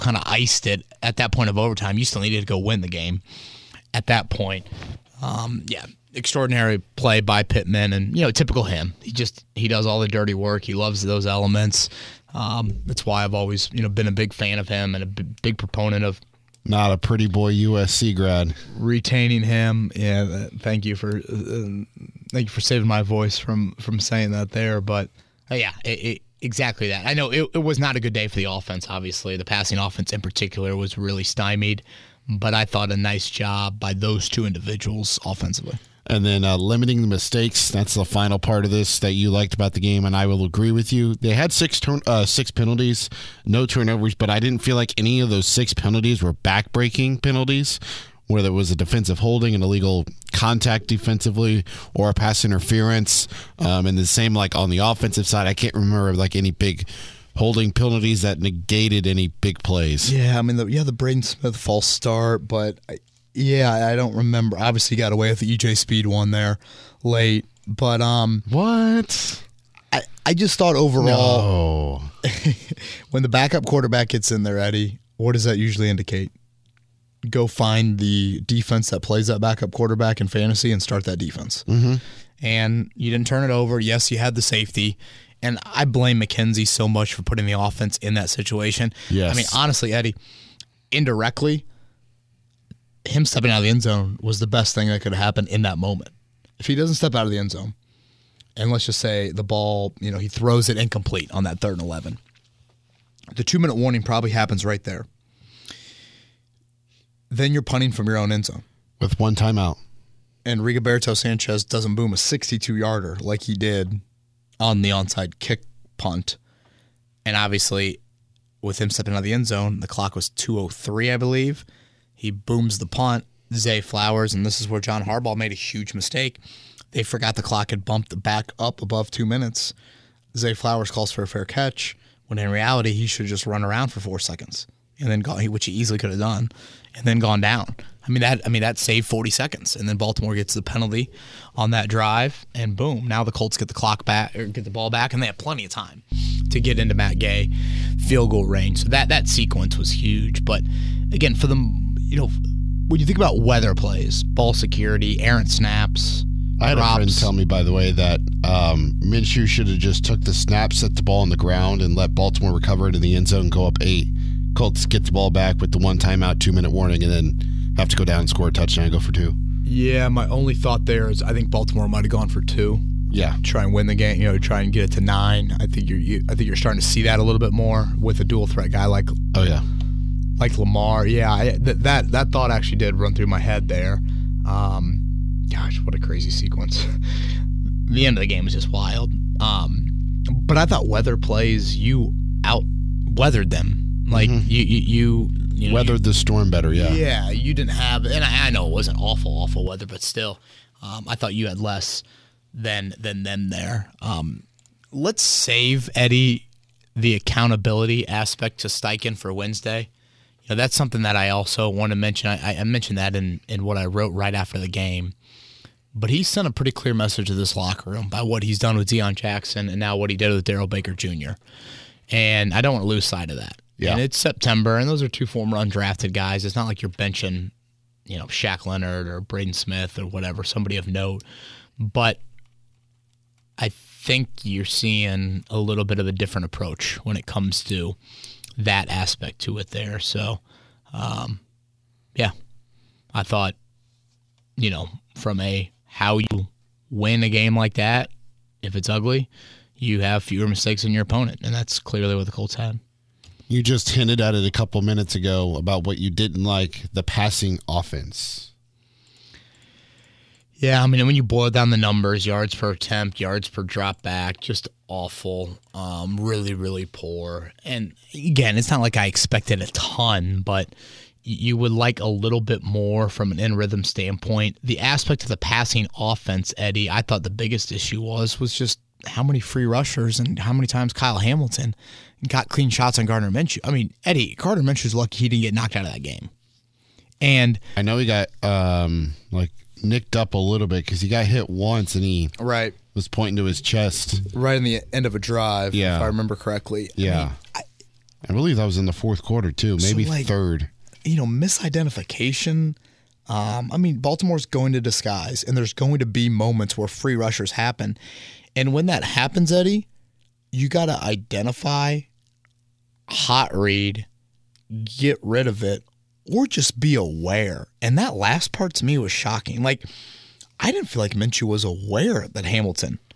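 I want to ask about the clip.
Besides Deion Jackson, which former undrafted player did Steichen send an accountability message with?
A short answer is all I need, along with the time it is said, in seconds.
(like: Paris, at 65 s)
Darrell Baker Jr., at 220 s.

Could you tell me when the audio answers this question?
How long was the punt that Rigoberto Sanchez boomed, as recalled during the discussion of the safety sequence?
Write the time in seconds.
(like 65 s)
112 s.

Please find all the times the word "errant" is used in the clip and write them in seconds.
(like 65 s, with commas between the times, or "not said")
155 s.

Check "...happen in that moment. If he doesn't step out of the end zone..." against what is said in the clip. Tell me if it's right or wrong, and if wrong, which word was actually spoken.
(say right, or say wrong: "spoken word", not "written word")
right.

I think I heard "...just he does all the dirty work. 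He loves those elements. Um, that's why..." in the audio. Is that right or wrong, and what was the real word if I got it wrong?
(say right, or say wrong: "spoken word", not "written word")
right.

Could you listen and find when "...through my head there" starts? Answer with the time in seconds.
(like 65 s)
183 s.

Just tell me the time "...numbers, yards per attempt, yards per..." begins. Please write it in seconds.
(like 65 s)
261 s.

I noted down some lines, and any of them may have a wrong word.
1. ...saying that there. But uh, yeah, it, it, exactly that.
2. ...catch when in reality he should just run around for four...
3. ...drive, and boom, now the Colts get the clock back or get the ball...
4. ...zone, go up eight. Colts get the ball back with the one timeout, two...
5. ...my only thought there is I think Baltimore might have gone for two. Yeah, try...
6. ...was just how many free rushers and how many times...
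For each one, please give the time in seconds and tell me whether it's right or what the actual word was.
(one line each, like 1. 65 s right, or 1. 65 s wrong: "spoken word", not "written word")
1. 23 s right
2. 131 s right
3. 141 s right
4. 163 s right
5. 170 s right
6. 278 s right.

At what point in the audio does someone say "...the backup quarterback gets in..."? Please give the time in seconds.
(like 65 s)
73 s.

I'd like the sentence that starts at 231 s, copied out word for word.
But I think you're seeing a little bit of a different approach when it comes to that aspect to it there.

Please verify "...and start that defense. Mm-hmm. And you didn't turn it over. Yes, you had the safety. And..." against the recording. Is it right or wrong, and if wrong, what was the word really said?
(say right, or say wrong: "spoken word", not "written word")
right.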